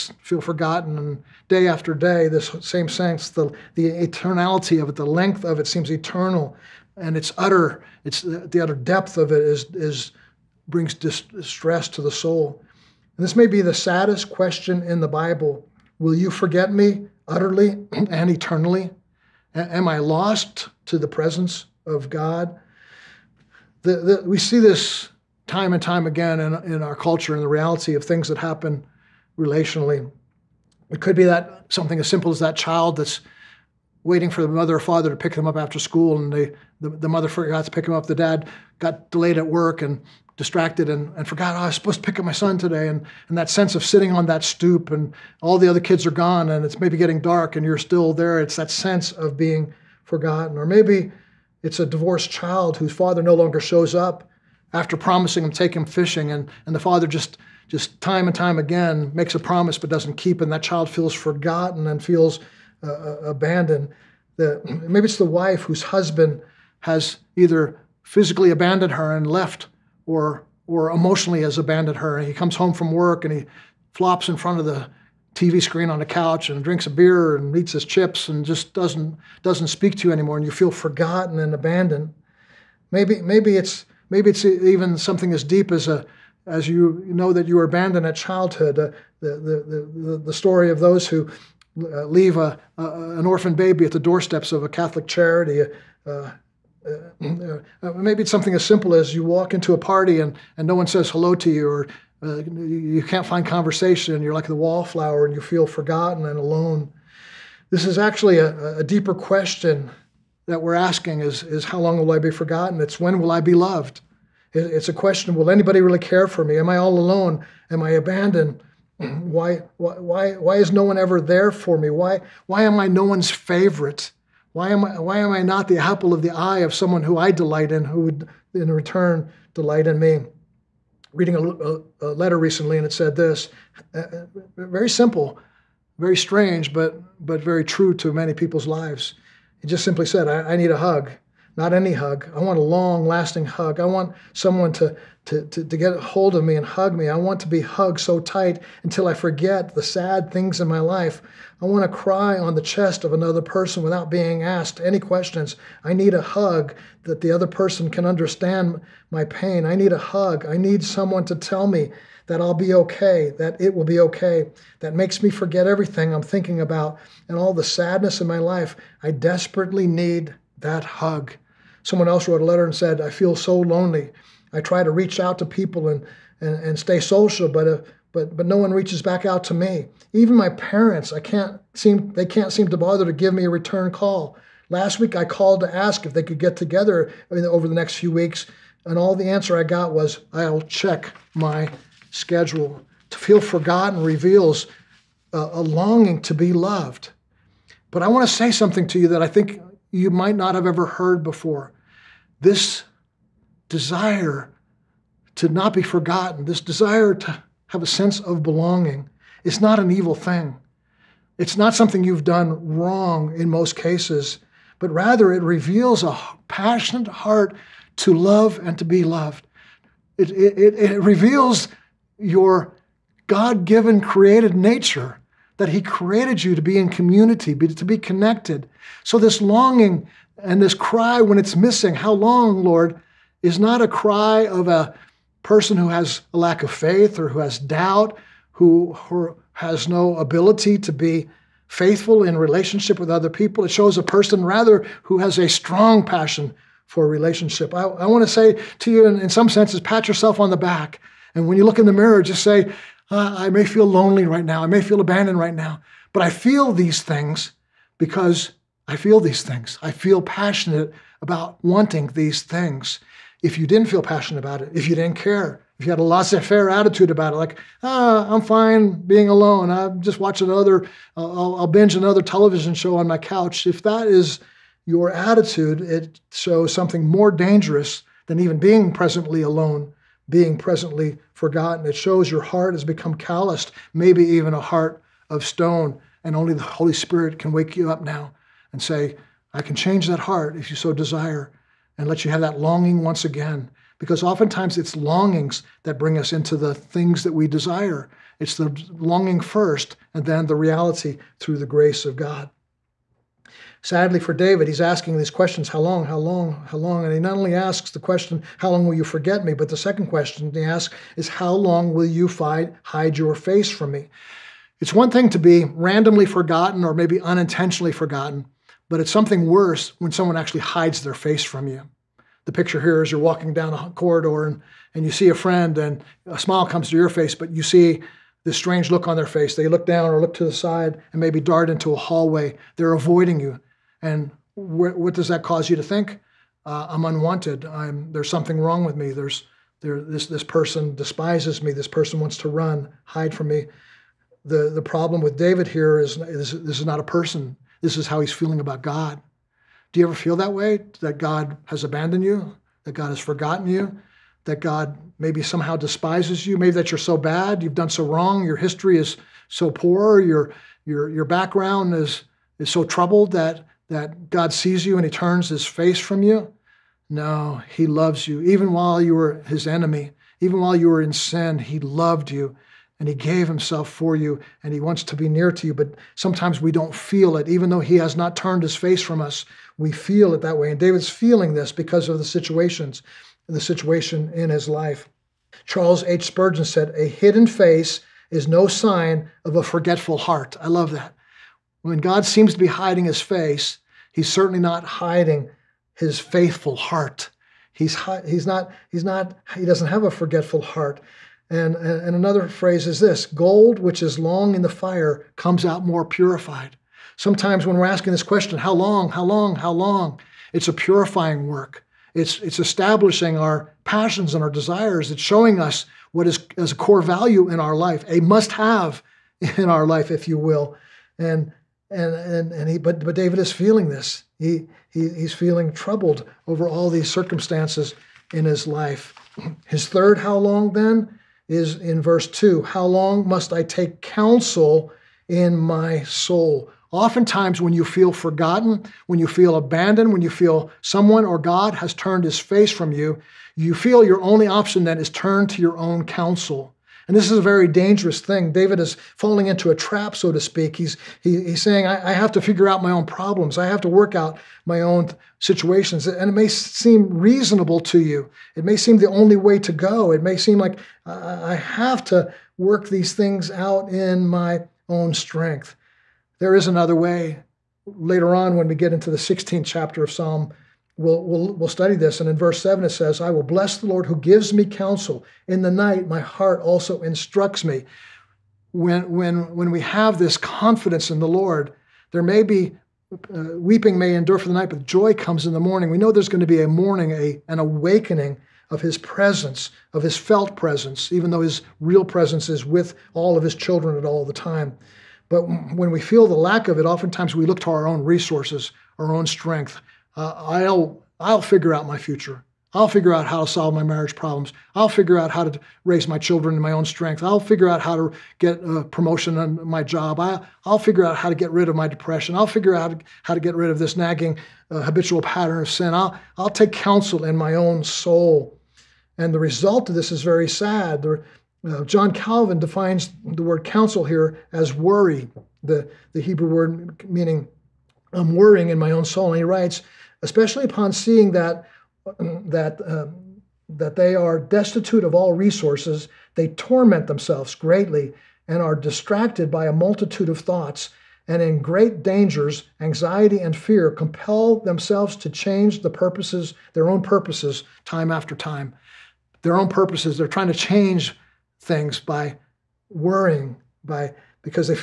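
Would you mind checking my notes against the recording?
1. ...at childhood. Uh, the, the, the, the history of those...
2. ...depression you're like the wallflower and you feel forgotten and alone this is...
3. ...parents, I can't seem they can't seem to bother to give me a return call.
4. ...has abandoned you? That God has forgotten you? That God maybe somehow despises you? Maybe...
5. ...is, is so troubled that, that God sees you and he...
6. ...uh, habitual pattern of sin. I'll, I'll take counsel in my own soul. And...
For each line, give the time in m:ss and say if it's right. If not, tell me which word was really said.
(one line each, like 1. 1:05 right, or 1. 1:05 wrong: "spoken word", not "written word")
1. 1:28 wrong: "story", not "history"
2. 1:43 wrong: "conversation", not "depression"
3. 3:00 right
4. 5:51 right
5. 6:01 right
6. 8:34 right.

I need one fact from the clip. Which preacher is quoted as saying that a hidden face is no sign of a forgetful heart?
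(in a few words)
Charles H. Spurgeon.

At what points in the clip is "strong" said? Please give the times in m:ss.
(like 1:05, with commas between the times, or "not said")
4:05.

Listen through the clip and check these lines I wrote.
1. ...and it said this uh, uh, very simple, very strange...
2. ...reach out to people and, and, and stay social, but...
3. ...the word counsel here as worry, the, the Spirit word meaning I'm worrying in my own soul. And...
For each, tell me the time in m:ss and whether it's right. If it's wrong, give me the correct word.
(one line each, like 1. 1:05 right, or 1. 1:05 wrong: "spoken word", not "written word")
1. 2:12 right
2. 2:54 right
3. 8:43 wrong: "Hebrew", not "Spirit".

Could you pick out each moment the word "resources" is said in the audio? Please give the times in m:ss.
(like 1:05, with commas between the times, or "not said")
8:18, 8:55.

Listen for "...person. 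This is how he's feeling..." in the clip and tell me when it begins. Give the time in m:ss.
5:47.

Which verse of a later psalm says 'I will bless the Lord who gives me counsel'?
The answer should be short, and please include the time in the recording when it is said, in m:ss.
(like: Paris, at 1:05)
Verse 7, at 7:52.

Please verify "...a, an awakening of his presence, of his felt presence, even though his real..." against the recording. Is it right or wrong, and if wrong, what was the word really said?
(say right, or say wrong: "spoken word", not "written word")
right.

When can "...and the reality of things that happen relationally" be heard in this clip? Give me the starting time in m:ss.
0:27.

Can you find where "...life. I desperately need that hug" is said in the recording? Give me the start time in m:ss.
2:48.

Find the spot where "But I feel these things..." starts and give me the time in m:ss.
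4:16.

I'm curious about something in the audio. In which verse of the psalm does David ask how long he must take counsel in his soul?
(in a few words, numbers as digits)
Verse 2.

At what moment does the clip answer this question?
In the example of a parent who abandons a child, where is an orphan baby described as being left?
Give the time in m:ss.
1:34.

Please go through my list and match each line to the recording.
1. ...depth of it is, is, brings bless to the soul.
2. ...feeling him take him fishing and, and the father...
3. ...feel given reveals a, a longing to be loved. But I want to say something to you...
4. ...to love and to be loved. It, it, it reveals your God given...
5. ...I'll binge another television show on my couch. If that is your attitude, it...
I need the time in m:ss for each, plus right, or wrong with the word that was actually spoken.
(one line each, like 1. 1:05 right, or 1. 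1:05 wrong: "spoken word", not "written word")
1. 0:08 wrong: "distress", not "bless"
2. 0:54 wrong: "promising", not "feeling"
3. 3:13 wrong: "forgotten", not "given"
4. 3:37 right
5. 4:31 right.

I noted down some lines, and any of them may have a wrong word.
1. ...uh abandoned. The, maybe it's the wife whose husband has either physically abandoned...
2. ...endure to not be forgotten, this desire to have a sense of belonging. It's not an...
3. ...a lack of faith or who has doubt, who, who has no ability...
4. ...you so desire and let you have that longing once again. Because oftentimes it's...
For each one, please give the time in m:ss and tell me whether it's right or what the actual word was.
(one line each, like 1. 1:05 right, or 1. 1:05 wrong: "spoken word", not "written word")
1. 1:02 right
2. 3:23 wrong: "desire", not "endure"
3. 3:56 right
4. 4:50 right.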